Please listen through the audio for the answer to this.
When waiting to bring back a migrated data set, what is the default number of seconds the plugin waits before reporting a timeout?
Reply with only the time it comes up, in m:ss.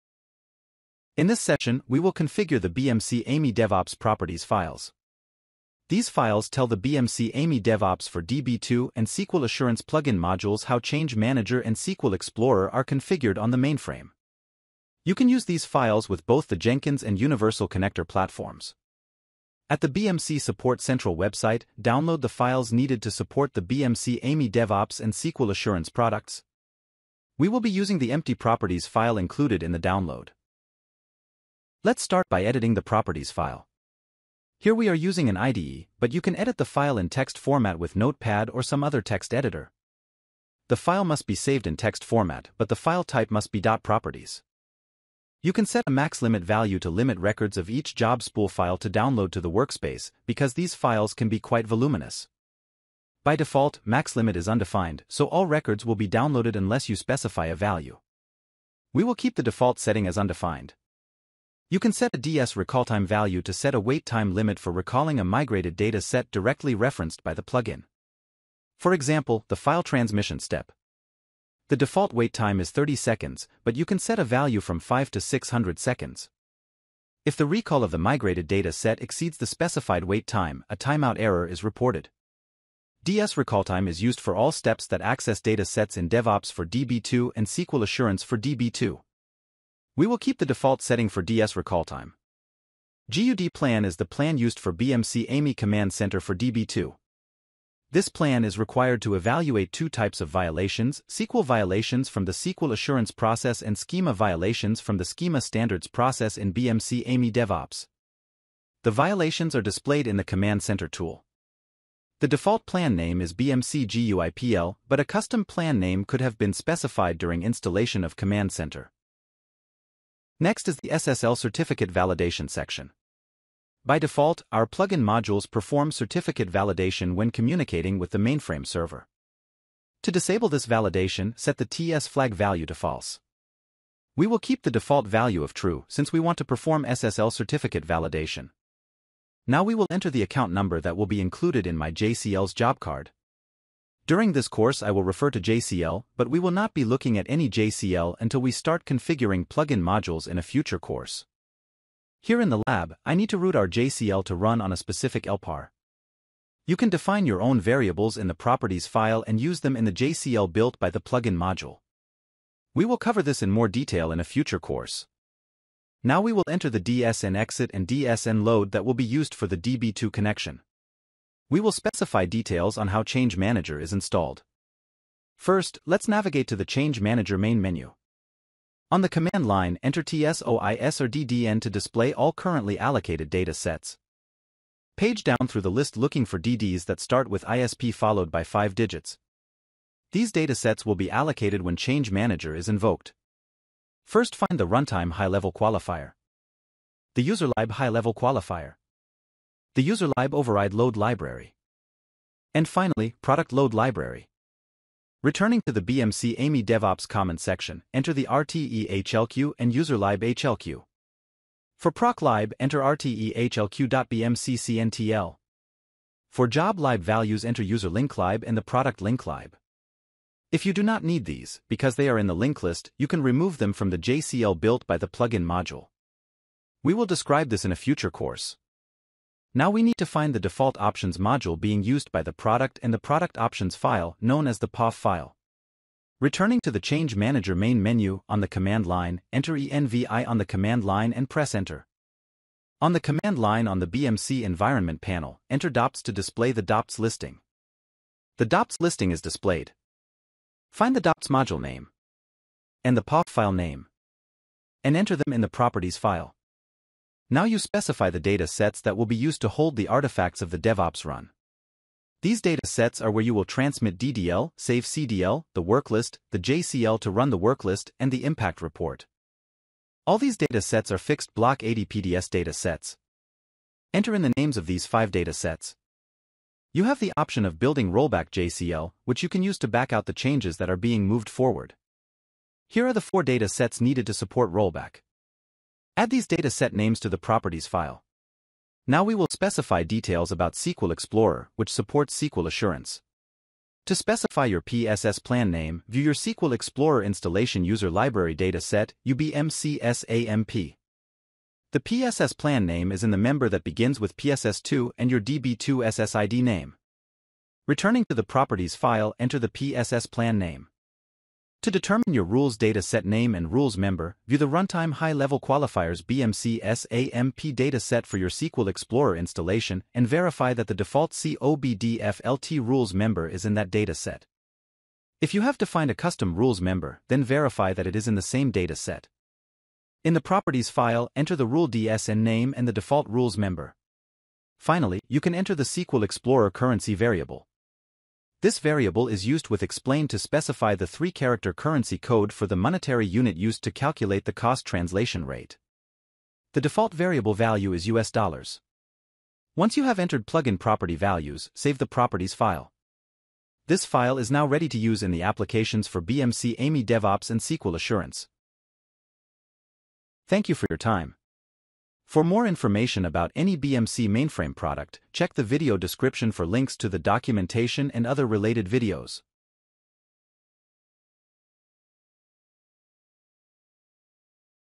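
1:12.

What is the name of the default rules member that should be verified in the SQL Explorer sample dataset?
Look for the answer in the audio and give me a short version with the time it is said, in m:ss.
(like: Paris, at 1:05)
COBDFLT, at 5:21.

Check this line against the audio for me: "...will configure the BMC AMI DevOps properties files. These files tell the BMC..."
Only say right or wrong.
right.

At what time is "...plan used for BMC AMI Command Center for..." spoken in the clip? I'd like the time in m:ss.
1:34.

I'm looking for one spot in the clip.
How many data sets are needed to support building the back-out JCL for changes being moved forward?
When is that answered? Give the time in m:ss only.
4:42.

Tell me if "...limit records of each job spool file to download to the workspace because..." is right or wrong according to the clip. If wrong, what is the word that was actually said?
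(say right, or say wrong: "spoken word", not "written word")
right.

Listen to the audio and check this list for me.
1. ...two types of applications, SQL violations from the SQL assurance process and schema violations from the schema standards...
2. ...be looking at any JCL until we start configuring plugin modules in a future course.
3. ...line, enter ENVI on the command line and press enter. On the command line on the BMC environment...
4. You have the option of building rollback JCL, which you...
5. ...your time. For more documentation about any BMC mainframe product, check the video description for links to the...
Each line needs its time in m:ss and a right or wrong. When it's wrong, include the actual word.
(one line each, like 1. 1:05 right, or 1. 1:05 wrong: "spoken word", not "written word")
1. 1:39 wrong: "violations", not "applications"
2. 2:26 right
3. 3:58 right
4. 4:36 right
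5. 6:00 wrong: "information", not "documentation".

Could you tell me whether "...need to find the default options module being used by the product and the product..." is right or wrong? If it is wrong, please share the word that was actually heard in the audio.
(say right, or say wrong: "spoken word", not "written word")
right.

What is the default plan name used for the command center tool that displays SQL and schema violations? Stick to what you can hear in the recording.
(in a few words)
BMC GUIPL.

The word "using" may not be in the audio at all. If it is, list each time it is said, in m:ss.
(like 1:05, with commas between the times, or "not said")
0:27, 0:34.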